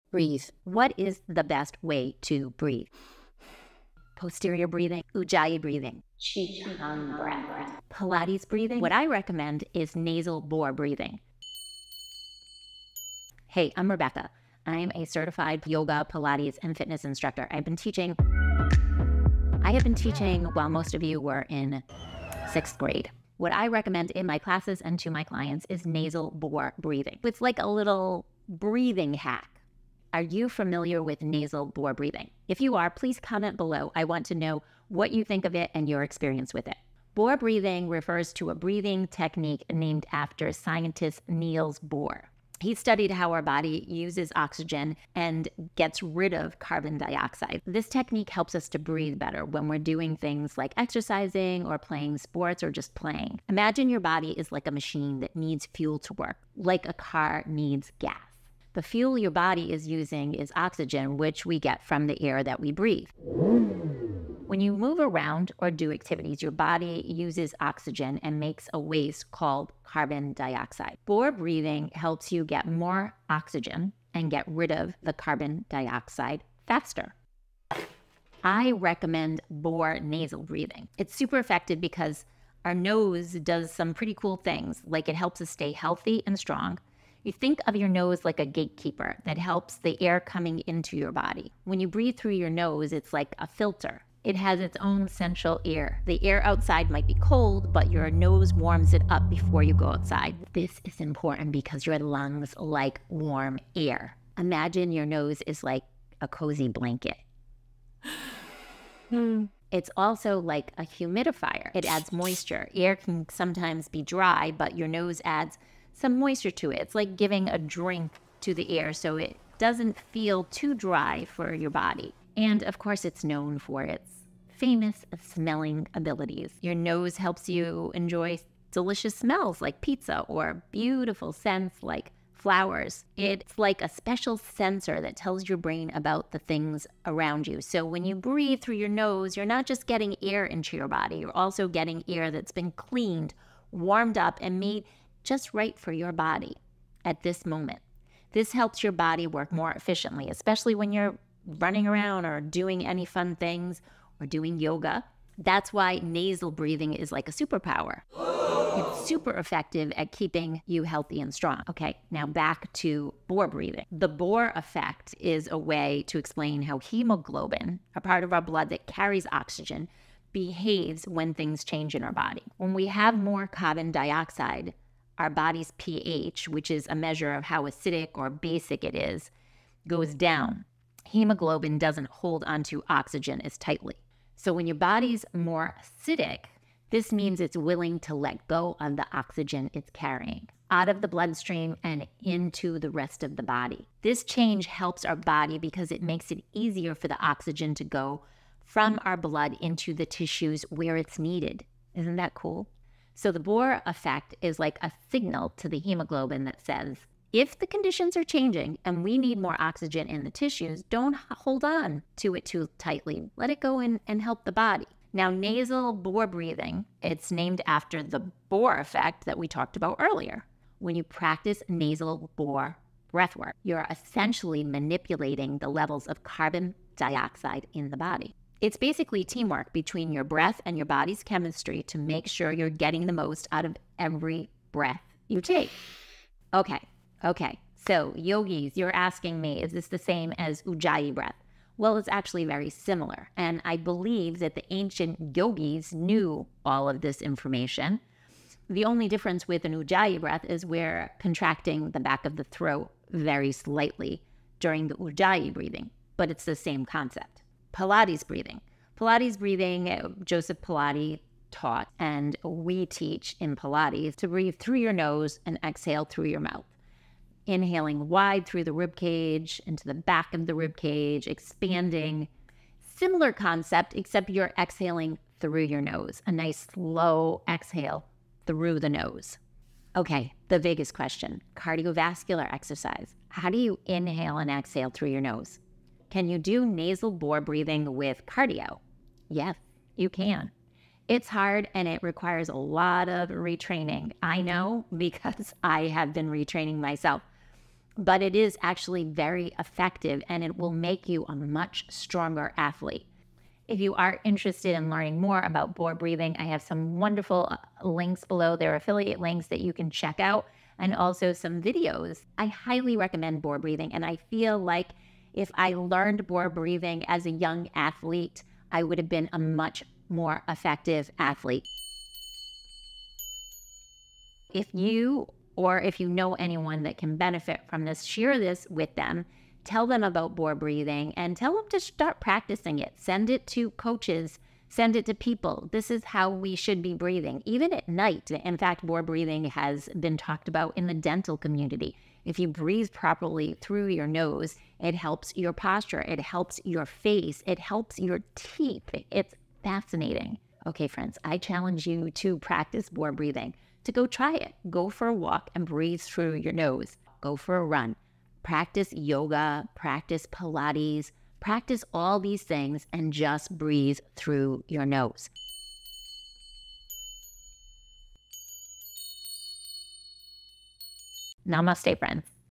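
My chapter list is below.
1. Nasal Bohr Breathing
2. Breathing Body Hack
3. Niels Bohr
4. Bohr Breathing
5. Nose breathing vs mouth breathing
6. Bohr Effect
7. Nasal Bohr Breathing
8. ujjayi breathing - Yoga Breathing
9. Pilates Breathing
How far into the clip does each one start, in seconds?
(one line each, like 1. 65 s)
1. 11 s
2. 26 s
3. 41 s
4. 54 s
5. 81 s
6. 164 s
7. 219 s
8. 237 s
9. 258 s.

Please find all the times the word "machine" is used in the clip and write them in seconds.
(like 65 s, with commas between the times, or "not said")
54 s.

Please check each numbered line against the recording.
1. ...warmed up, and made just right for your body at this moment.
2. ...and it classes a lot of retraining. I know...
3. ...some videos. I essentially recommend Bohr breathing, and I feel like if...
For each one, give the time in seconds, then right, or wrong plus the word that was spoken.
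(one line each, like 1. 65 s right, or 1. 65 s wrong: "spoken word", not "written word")
1. 143 s right
2. 291 s wrong: "requires", not "classes"
3. 311 s wrong: "highly", not "essentially".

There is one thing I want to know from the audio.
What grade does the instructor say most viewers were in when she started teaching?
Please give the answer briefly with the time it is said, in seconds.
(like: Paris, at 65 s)
6th grade, at 22 s.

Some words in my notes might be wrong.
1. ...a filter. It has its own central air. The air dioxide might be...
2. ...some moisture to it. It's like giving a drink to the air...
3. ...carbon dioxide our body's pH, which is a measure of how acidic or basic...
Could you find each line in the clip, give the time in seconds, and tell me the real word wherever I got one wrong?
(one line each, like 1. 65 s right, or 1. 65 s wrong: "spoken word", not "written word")
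1. 93 s wrong: "outside", not "dioxide"
2. 116 s right
3. 173 s right.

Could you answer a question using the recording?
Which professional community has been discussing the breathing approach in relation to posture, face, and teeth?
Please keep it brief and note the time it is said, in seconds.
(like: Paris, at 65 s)
Dental community, at 340 s.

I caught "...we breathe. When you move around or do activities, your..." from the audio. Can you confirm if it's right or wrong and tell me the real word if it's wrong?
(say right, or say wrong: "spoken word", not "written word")
right.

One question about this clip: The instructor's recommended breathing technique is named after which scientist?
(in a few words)
Niels Bohr.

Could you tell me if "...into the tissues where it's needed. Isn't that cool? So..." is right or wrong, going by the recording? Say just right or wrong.
right.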